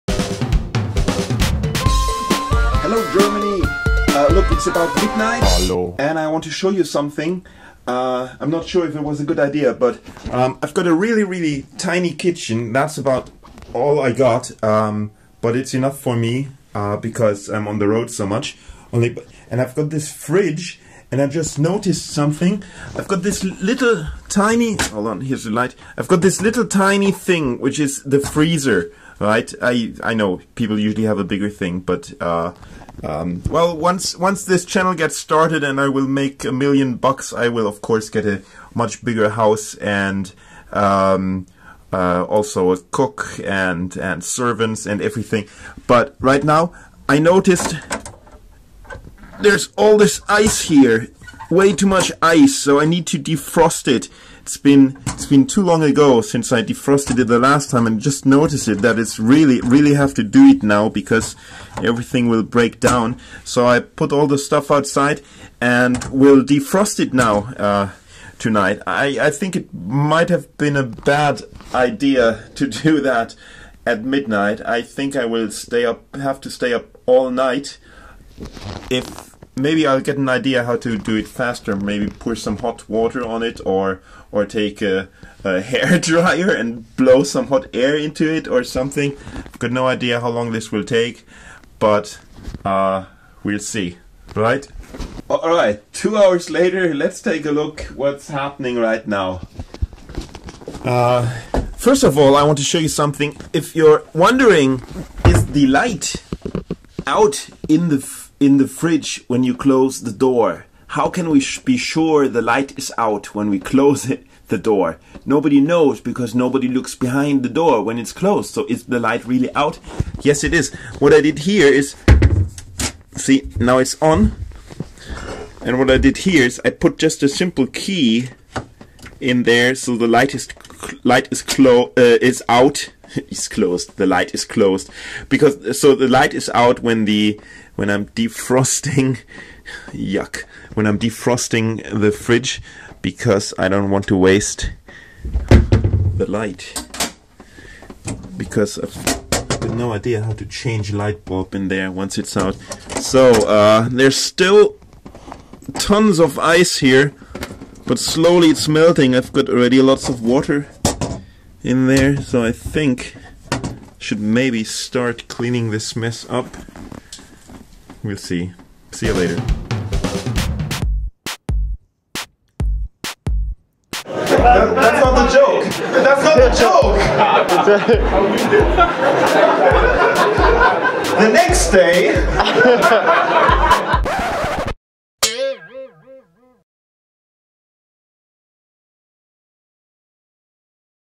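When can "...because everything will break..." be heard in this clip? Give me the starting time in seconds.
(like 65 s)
60 s.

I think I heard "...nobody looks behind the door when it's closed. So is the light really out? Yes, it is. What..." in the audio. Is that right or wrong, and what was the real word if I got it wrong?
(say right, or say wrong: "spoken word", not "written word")
right.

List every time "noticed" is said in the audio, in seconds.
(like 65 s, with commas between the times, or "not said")
21 s, 47 s, 58 s.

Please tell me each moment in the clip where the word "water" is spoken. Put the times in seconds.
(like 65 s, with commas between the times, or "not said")
82 s, 160 s.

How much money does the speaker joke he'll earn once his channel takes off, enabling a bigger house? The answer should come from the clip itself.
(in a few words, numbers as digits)
a million bucks.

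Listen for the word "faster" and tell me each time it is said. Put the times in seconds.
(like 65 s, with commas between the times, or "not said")
81 s.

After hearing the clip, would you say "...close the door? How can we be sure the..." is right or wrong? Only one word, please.
right.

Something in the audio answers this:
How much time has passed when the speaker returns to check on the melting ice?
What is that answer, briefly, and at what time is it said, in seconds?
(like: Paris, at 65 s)
2 hours, at 95 s.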